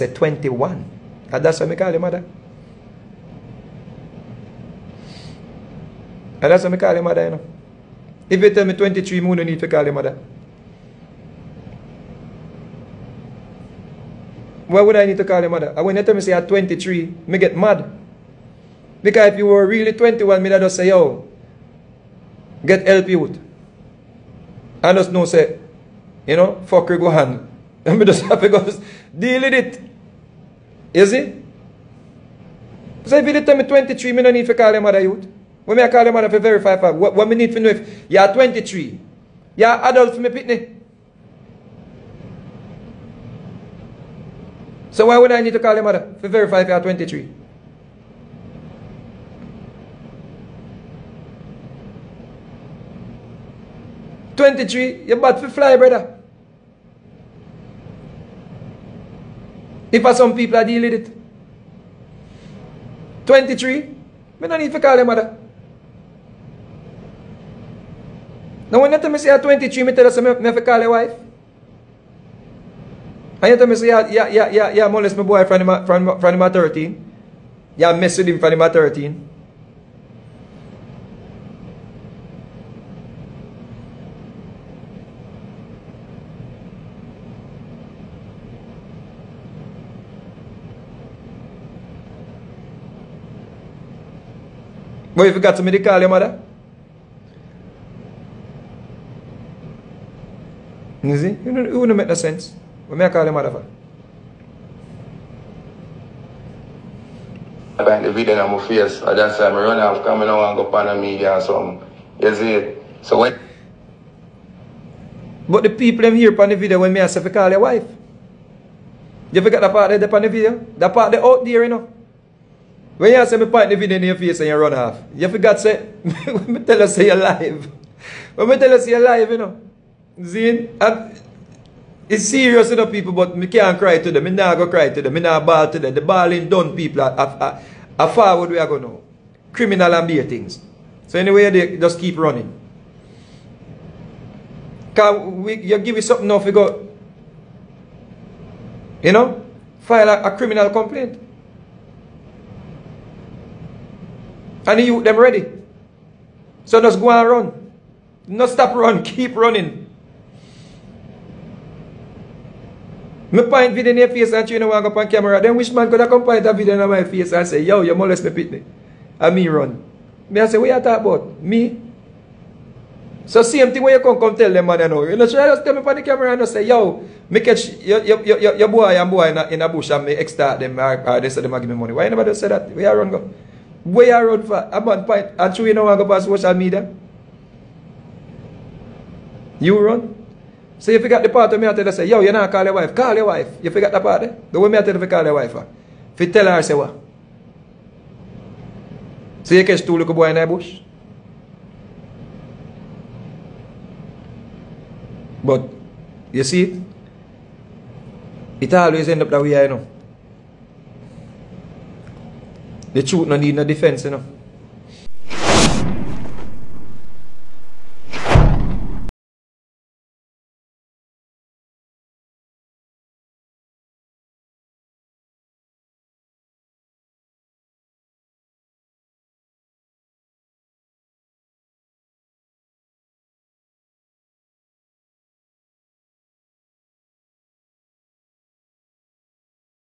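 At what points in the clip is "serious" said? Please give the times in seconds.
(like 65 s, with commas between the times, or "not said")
132 s.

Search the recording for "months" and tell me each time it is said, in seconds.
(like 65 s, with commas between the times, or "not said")
9 s.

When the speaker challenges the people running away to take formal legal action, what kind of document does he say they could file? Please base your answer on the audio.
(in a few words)
criminal complaint.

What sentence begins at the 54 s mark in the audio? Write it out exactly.
Twenty-three, you're about to fly, brother.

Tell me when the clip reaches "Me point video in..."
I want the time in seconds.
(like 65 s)
163 s.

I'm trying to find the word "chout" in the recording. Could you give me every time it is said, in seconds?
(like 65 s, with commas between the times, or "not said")
213 s.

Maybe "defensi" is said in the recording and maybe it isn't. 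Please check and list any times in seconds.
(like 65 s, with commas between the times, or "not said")
213 s.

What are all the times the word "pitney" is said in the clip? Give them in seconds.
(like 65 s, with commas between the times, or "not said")
40 s, 168 s.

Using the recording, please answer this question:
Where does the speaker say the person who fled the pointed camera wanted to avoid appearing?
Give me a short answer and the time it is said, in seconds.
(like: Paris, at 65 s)
social media, at 186 s.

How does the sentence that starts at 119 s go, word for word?
You forget that part there on the video?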